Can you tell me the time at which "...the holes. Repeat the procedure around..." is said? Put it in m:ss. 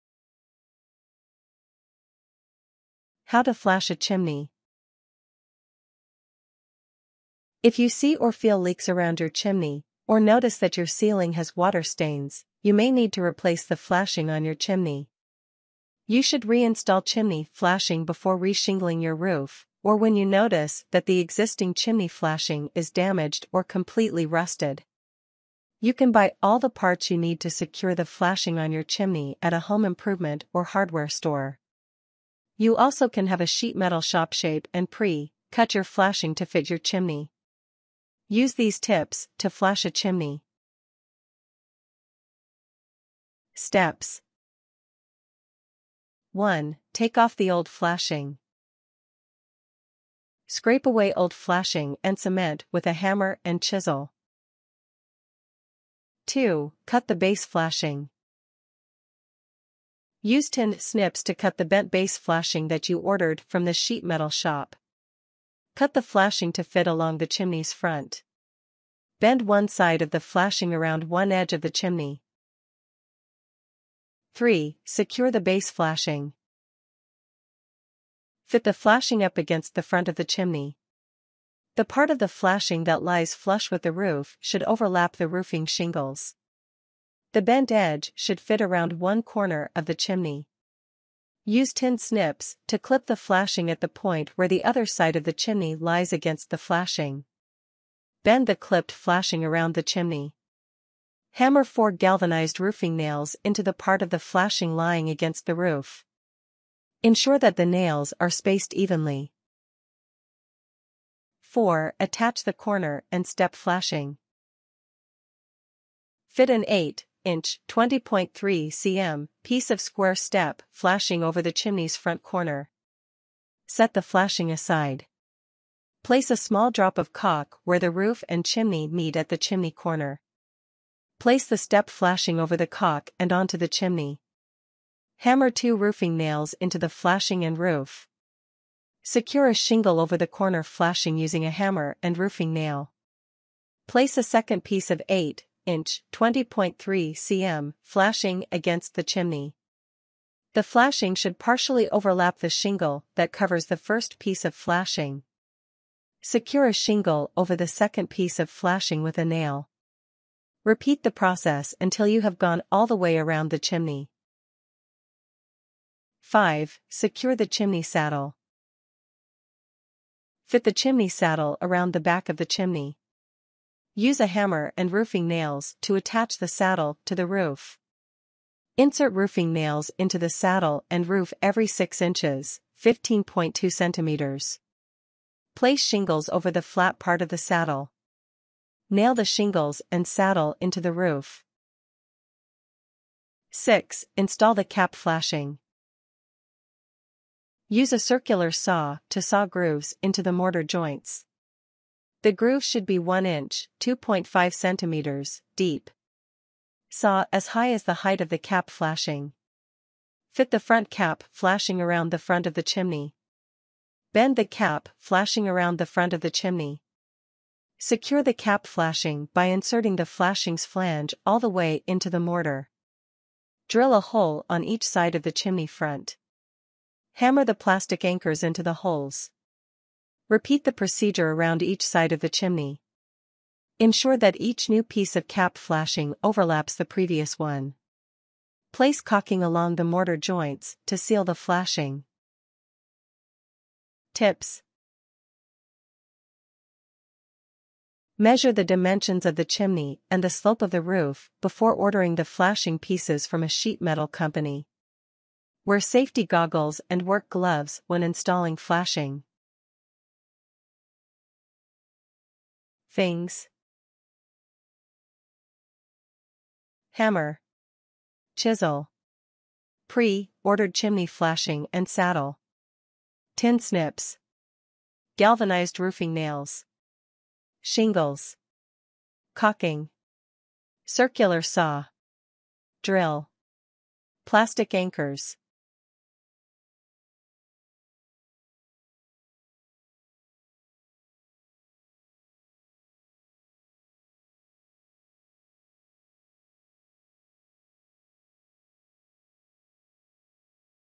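3:48.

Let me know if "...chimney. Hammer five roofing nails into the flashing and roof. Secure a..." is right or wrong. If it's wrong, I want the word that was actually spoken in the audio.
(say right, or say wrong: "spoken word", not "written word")
wrong: "two", not "five".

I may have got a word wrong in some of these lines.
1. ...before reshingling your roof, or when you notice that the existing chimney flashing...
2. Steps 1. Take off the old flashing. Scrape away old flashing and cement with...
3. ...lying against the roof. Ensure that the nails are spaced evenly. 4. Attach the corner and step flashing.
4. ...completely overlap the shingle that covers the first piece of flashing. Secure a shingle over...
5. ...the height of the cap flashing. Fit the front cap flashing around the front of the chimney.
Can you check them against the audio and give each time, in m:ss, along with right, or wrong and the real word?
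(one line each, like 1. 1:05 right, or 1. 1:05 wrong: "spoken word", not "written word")
1. 0:18 right
2. 0:43 right
3. 1:44 right
4. 2:31 wrong: "partially", not "completely"
5. 3:27 right.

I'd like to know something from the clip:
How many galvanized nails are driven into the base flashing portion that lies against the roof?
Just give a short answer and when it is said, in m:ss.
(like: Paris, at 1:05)
4, at 1:41.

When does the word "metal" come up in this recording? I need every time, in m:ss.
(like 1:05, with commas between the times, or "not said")
0:33, 1:04, 4:13.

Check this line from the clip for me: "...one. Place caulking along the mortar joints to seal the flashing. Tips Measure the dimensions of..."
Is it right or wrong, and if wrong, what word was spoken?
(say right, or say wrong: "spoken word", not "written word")
right.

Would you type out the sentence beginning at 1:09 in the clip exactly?
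Bend one side of the flashing around one edge of the chimney.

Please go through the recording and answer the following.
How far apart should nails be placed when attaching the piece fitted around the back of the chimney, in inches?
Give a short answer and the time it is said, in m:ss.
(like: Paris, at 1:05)
6 inches, at 3:01.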